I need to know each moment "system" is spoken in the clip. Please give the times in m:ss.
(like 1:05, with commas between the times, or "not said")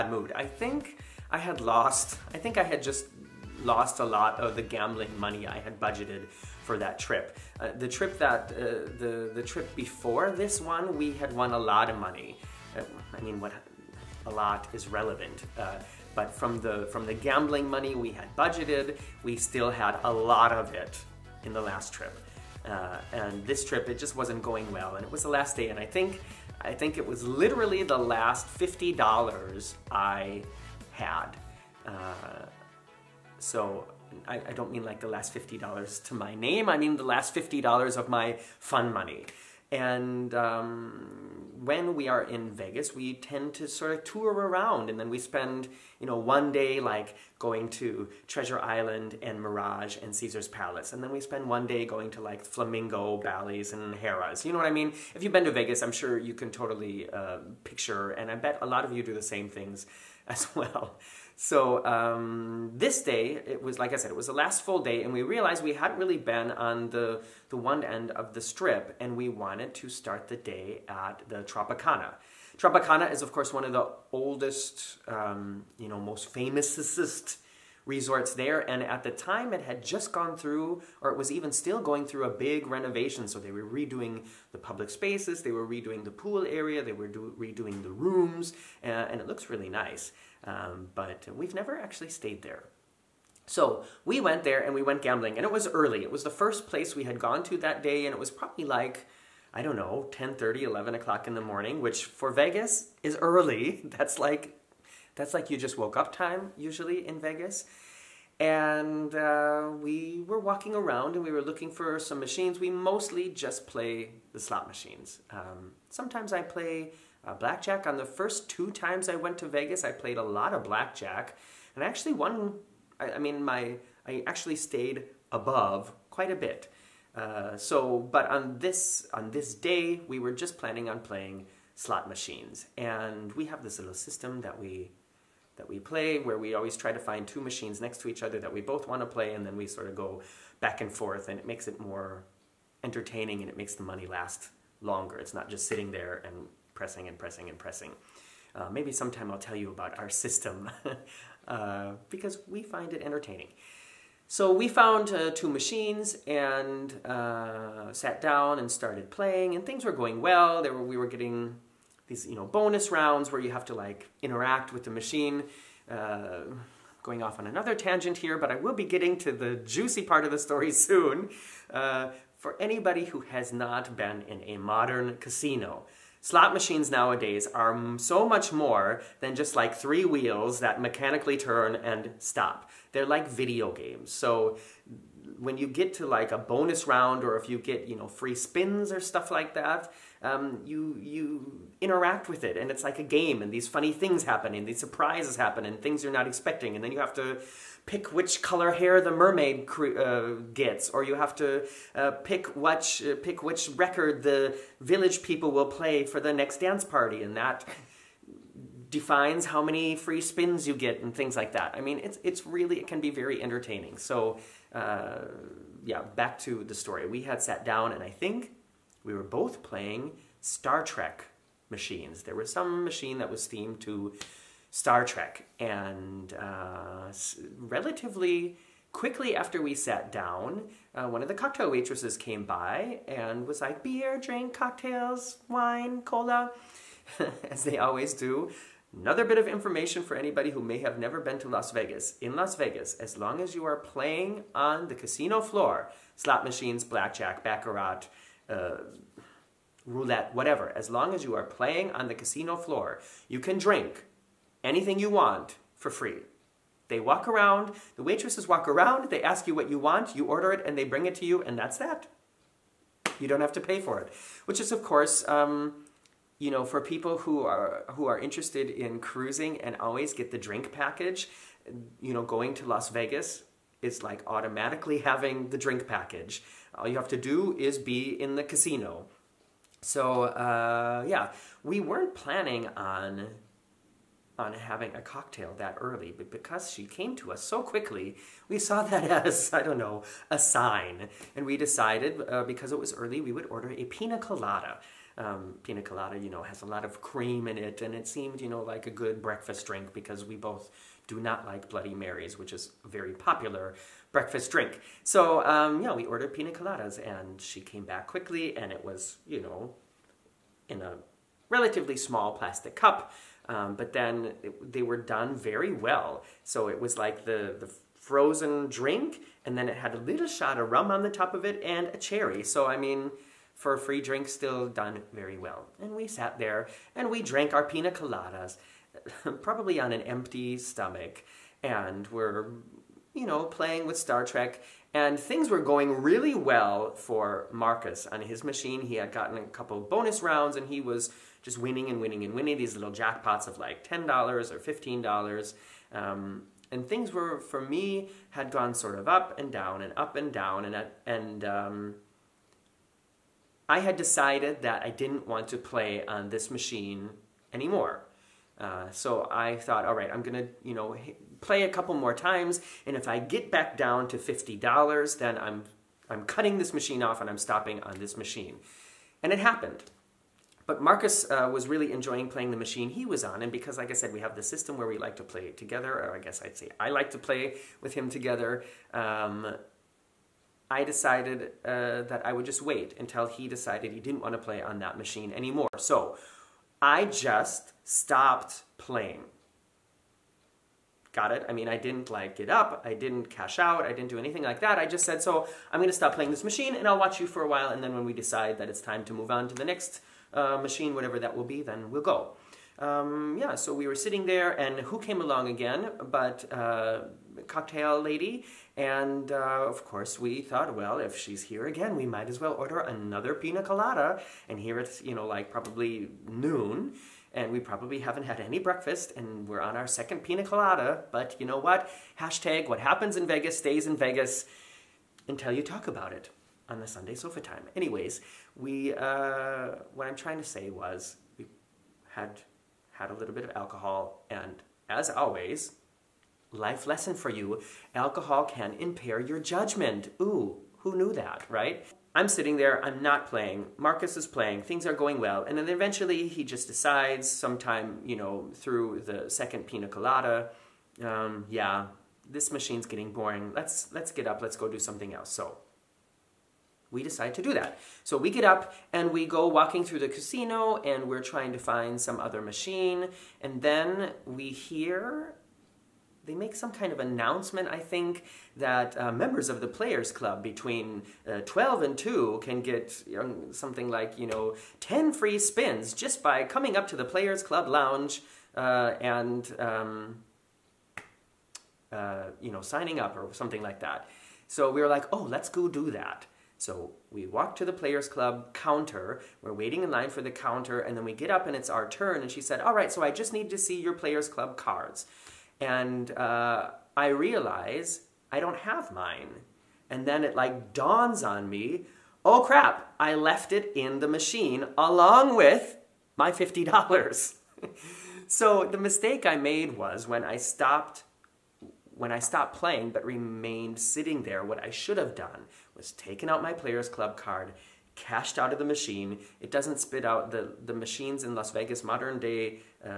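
2:13, 2:30, 6:14.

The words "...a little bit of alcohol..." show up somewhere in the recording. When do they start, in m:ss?
7:13.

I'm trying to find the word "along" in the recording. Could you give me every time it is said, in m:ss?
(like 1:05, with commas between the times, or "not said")
6:45, 8:24.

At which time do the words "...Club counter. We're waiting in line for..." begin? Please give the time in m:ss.
8:08.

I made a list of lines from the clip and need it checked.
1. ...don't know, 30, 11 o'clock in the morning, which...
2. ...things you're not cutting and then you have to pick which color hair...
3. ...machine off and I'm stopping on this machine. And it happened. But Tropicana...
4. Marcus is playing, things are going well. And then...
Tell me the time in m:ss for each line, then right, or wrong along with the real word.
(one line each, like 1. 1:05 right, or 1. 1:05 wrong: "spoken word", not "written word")
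1. 1:39 right
2. 3:15 wrong: "expecting", not "cutting"
3. 6:06 wrong: "Marcus", not "Tropicana"
4. 7:23 right.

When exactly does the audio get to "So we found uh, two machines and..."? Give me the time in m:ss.
2:34.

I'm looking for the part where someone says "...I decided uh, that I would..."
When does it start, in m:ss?
6:20.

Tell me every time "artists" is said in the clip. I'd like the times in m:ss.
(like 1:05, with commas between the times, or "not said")
not said.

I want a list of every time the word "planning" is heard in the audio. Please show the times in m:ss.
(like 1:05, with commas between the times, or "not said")
2:10, 4:42.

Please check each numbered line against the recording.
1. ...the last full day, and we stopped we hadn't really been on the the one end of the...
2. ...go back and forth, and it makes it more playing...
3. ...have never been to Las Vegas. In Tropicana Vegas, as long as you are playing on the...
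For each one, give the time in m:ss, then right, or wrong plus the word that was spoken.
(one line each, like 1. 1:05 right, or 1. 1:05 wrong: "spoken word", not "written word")
1. 1:04 wrong: "realized", not "stopped"
2. 2:19 wrong: "entertaining", not "playing"
3. 4:00 wrong: "Las", not "Tropicana".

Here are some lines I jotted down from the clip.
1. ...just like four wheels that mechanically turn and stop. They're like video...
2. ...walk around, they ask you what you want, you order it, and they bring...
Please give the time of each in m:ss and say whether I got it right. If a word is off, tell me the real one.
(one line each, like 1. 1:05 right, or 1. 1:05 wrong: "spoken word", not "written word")
1. 2:59 wrong: "three", not "four"
2. 4:18 right.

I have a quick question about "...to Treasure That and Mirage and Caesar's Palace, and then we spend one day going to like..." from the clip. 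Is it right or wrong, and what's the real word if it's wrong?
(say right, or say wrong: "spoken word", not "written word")
wrong: "Island", not "That".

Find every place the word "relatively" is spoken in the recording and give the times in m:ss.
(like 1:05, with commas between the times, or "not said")
3:47, 5:11.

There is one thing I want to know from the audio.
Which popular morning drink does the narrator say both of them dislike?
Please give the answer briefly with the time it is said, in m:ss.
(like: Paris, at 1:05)
Bloody Marys, at 5:01.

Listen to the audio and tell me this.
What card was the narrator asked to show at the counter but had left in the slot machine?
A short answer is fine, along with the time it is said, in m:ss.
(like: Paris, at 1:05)
Players Club card, at 8:13.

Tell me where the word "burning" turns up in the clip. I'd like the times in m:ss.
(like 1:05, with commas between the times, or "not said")
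not said.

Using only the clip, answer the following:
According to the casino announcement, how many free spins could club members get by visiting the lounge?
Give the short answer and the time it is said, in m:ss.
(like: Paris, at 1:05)
10, at 7:54.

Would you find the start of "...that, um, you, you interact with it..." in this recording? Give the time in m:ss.
3:09.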